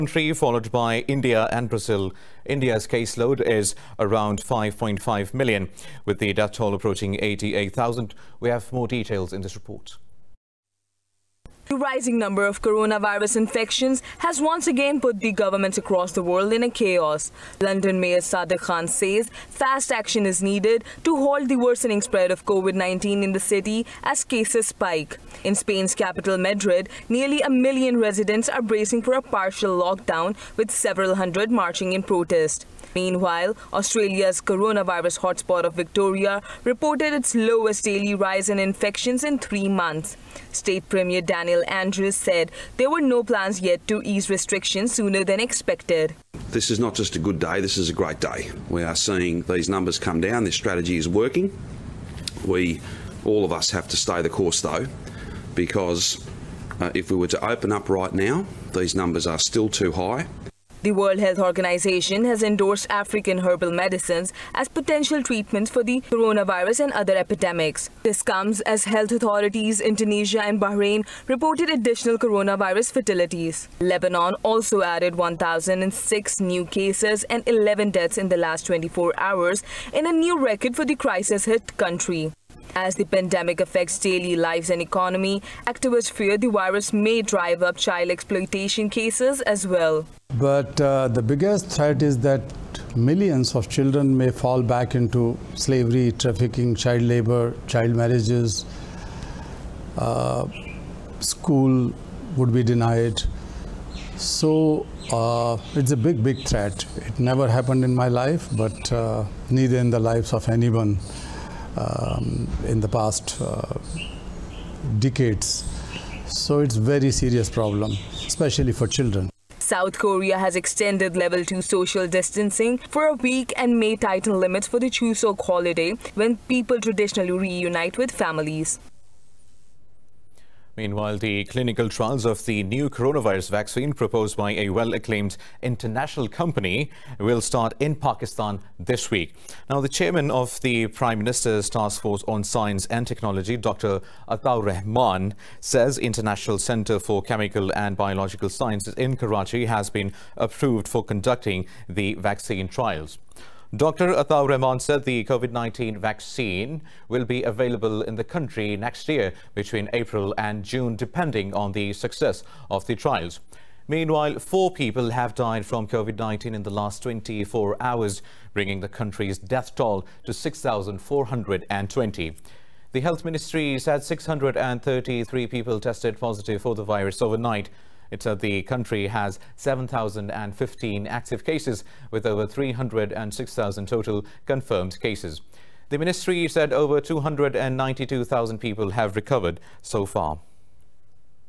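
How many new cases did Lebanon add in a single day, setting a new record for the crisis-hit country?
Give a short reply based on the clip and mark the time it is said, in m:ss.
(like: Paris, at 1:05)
1,006, at 1:15.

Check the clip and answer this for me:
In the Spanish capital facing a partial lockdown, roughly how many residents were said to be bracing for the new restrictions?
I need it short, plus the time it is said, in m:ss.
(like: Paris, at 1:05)
nearly a million, at 0:27.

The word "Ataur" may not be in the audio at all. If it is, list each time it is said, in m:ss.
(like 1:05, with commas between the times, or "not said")
2:24, 2:34.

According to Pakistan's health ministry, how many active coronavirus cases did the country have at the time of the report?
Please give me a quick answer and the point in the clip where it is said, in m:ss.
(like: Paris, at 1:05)
7,015, at 2:59.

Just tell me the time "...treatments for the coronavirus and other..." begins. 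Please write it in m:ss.
1:05.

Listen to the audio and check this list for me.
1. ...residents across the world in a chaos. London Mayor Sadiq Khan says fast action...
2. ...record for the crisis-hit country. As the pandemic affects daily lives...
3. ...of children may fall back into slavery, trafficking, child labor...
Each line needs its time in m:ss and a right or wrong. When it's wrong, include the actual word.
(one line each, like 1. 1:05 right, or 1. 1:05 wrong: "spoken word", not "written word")
1. 0:15 wrong: "governments", not "residents"
2. 1:20 right
3. 1:33 right.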